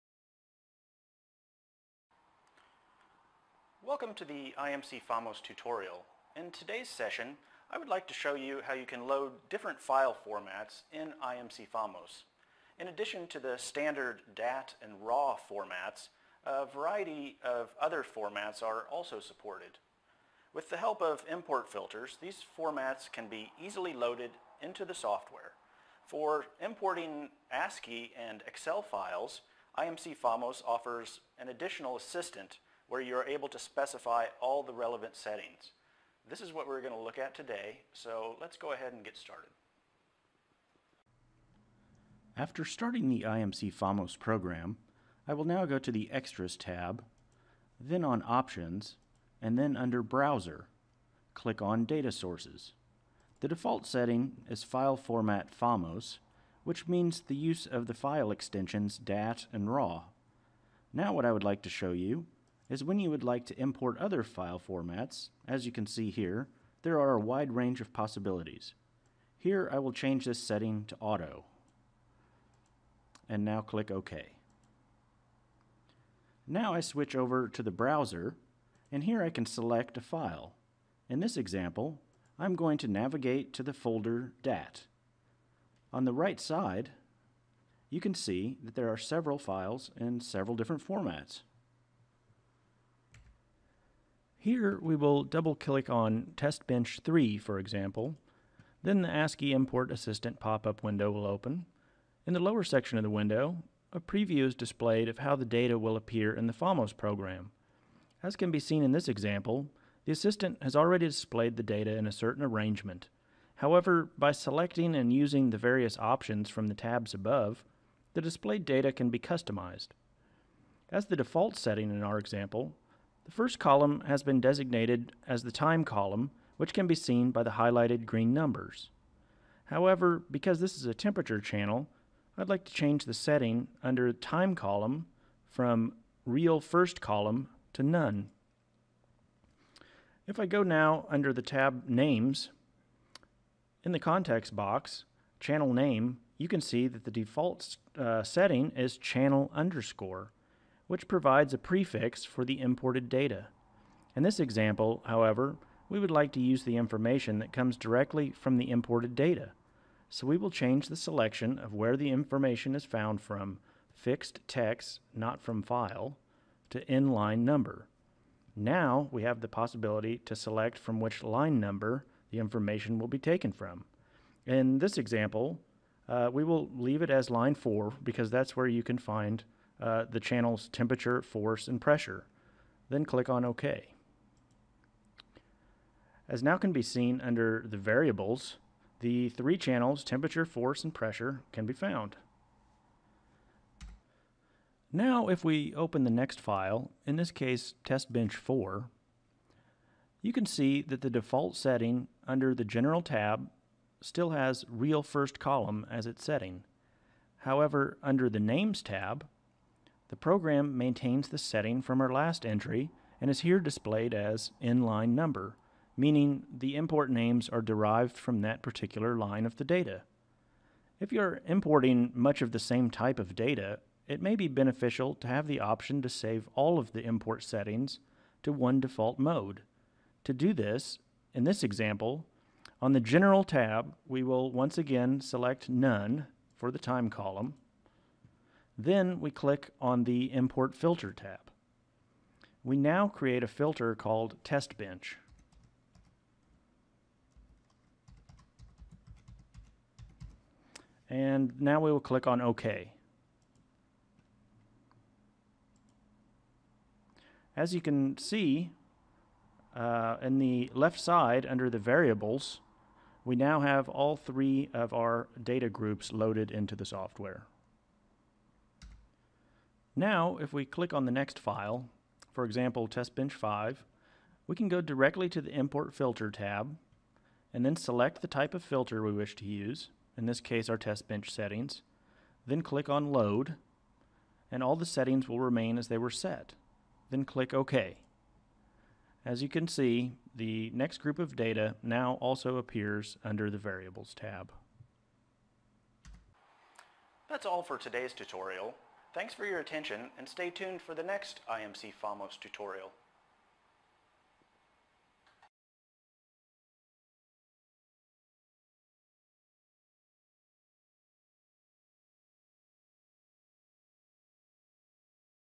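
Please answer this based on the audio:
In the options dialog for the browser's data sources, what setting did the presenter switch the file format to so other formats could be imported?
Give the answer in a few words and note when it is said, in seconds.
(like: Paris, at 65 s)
auto, at 71 s.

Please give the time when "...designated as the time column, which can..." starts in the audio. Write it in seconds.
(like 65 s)
124 s.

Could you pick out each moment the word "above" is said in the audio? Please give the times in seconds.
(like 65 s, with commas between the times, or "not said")
117 s.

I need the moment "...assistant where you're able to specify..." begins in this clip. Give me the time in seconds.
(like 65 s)
31 s.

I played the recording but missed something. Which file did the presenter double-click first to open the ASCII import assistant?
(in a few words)
Test Bench 3.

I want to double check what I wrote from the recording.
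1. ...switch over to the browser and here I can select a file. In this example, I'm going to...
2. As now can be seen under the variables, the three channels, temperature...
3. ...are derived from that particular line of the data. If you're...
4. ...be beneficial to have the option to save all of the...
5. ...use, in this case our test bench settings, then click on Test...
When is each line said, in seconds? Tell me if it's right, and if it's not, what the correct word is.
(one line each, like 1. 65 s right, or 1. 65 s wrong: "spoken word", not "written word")
1. 76 s right
2. 186 s right
3. 217 s right
4. 224 s right
5. 279 s wrong: "Load", not "Test".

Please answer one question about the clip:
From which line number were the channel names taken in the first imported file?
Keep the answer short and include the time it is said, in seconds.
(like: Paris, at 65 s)
4, at 177 s.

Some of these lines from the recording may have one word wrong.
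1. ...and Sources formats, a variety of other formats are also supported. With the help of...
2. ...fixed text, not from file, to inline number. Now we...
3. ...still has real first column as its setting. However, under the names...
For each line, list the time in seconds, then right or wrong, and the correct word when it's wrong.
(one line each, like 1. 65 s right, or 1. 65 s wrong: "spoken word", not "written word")
1. 14 s wrong: "RAW", not "Sources"
2. 163 s right
3. 203 s right.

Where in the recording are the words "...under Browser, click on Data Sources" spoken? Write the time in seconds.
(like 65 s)
49 s.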